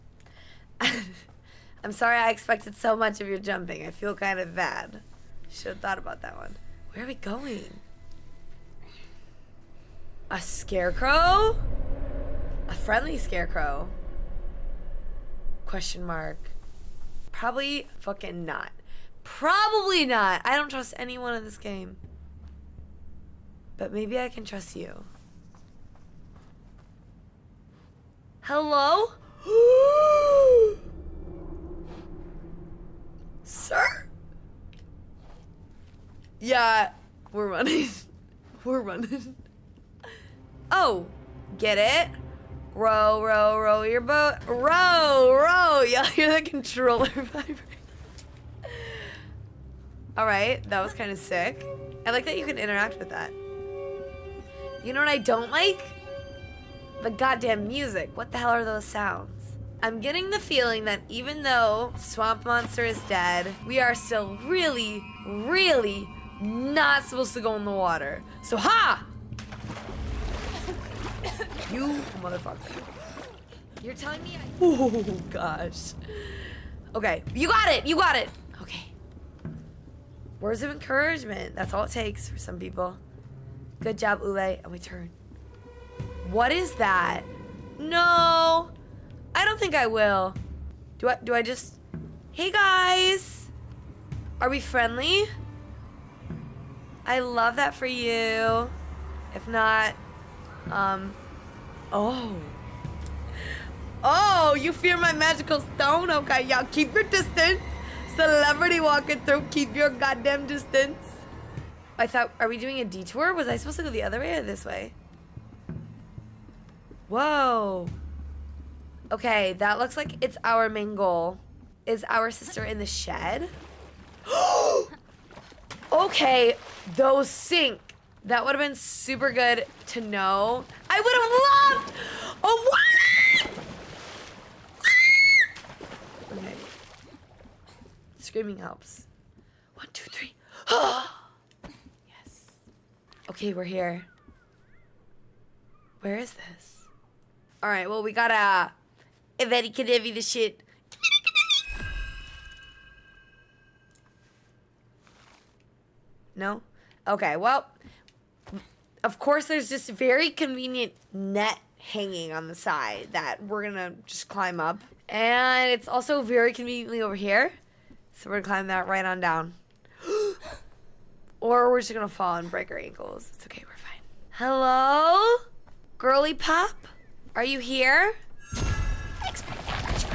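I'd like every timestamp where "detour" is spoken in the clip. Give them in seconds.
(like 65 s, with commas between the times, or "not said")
112 s.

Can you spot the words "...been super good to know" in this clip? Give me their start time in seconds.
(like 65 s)
128 s.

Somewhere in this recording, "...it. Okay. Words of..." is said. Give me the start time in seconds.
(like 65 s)
78 s.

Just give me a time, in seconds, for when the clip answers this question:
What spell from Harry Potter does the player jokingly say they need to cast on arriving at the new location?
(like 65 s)
149 s.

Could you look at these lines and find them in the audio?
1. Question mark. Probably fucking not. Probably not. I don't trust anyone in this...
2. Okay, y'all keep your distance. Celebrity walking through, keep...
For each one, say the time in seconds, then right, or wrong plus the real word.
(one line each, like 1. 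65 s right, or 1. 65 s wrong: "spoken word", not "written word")
1. 15 s right
2. 106 s right.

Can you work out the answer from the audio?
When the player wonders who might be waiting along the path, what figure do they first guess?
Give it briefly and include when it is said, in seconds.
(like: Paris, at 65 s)
A scarecrow, at 10 s.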